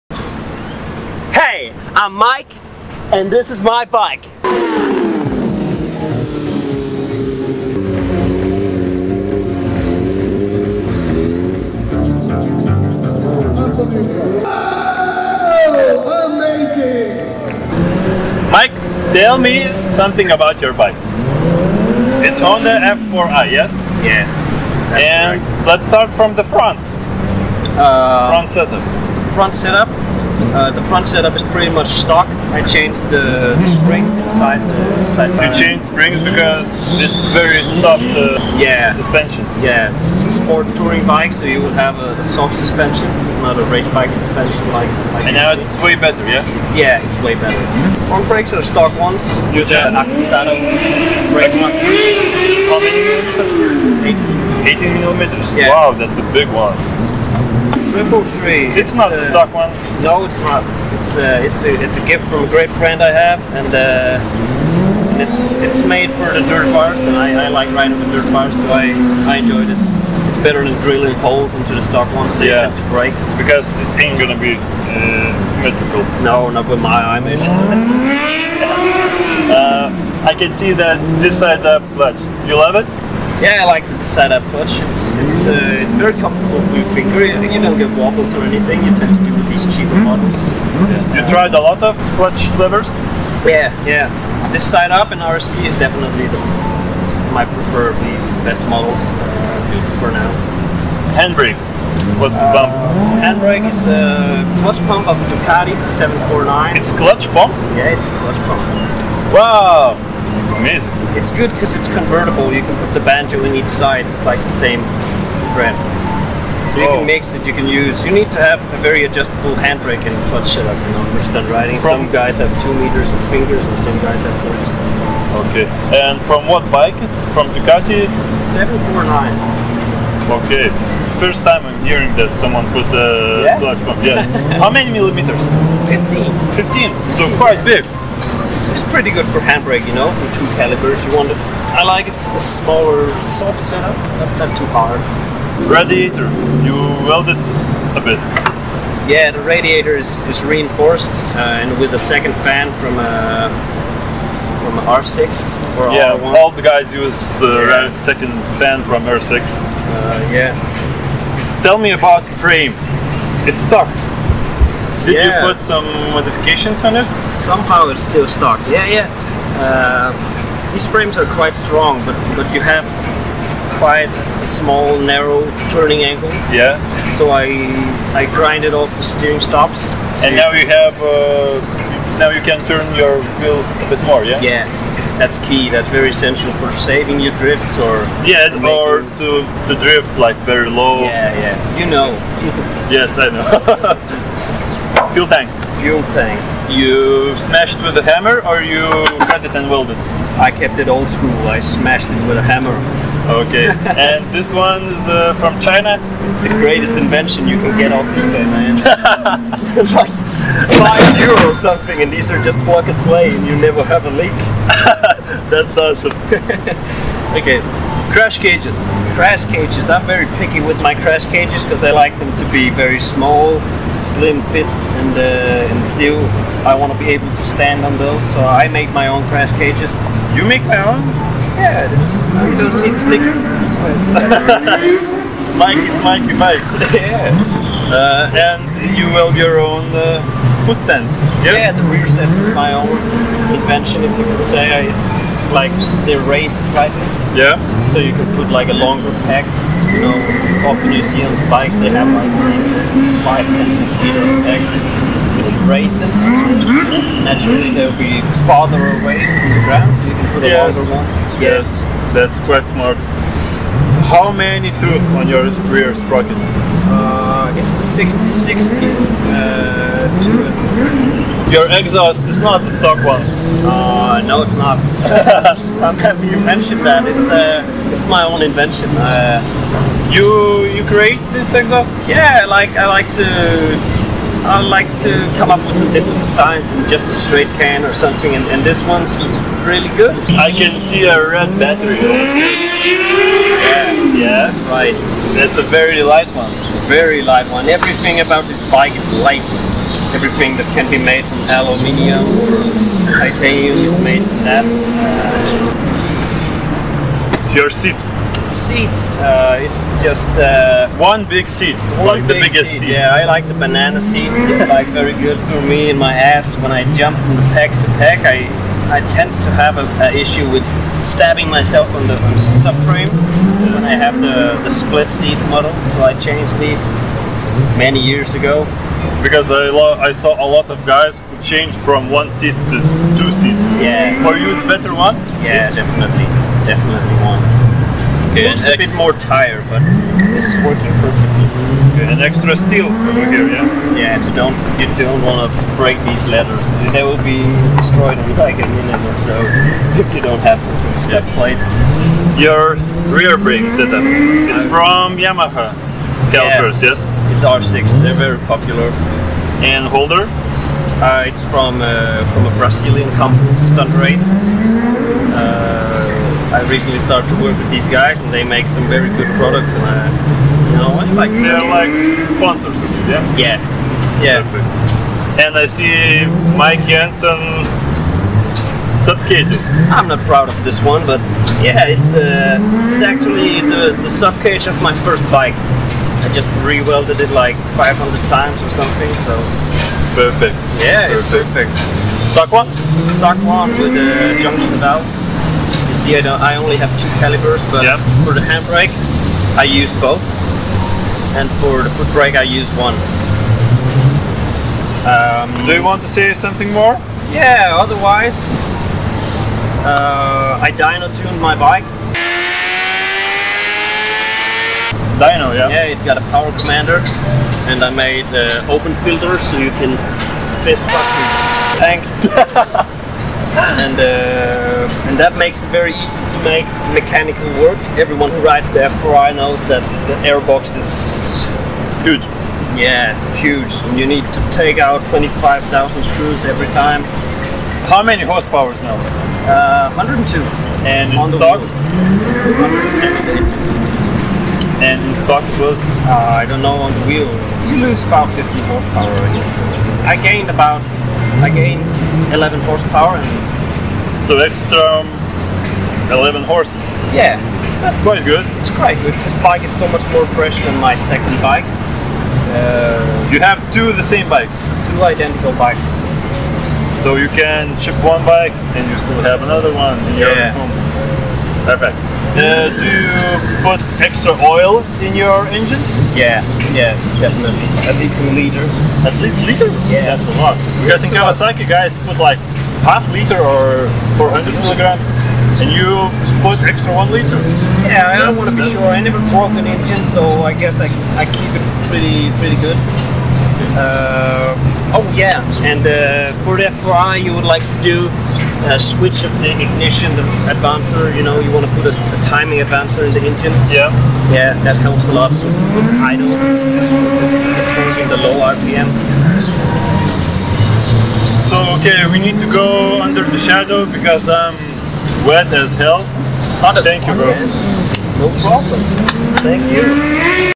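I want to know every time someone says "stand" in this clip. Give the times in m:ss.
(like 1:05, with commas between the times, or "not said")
3:47, 4:00.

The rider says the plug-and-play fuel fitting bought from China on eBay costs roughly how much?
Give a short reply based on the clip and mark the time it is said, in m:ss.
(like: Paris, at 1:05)
5 euro, at 3:30.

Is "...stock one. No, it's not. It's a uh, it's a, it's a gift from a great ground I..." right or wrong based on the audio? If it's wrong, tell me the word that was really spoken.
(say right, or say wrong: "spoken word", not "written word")
wrong: "friend", not "ground".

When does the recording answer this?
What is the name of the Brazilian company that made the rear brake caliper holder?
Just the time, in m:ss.
6:03.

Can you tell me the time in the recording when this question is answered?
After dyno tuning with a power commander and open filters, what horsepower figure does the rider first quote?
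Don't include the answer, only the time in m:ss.
7:19.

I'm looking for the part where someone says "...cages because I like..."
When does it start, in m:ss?
3:41.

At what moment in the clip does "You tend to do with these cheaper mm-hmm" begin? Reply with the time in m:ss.
1:28.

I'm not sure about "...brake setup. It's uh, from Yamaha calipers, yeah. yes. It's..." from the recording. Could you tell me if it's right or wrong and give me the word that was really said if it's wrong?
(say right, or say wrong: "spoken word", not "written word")
right.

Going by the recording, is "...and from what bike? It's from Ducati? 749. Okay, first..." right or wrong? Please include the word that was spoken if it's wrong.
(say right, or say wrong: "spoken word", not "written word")
right.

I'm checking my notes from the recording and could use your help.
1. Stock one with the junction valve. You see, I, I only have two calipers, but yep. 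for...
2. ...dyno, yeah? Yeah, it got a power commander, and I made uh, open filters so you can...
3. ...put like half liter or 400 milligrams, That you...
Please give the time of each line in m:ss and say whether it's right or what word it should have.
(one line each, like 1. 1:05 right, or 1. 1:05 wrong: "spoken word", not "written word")
1. 6:33 right
2. 6:55 right
3. 8:02 wrong: "And", not "That".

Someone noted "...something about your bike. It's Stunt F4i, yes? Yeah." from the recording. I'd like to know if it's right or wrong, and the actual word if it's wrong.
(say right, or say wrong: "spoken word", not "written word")
wrong: "Honda", not "Stunt".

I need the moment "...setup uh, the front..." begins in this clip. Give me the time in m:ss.
0:29.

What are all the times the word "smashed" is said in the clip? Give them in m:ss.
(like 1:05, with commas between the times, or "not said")
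3:17, 3:21.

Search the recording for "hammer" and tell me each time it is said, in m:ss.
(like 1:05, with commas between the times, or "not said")
3:18, 3:22.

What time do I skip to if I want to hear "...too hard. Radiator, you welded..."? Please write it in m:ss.
2:24.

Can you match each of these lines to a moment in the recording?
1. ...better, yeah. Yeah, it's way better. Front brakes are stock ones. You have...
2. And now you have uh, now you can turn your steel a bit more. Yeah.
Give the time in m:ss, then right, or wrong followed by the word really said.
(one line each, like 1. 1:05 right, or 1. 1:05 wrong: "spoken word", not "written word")
1. 0:45 right
2. 3:00 wrong: "wheel", not "steel".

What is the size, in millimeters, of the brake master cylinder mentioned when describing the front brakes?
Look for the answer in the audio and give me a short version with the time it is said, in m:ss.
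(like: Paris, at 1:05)
18, at 0:54.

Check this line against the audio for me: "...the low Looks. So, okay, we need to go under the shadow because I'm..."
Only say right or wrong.
wrong.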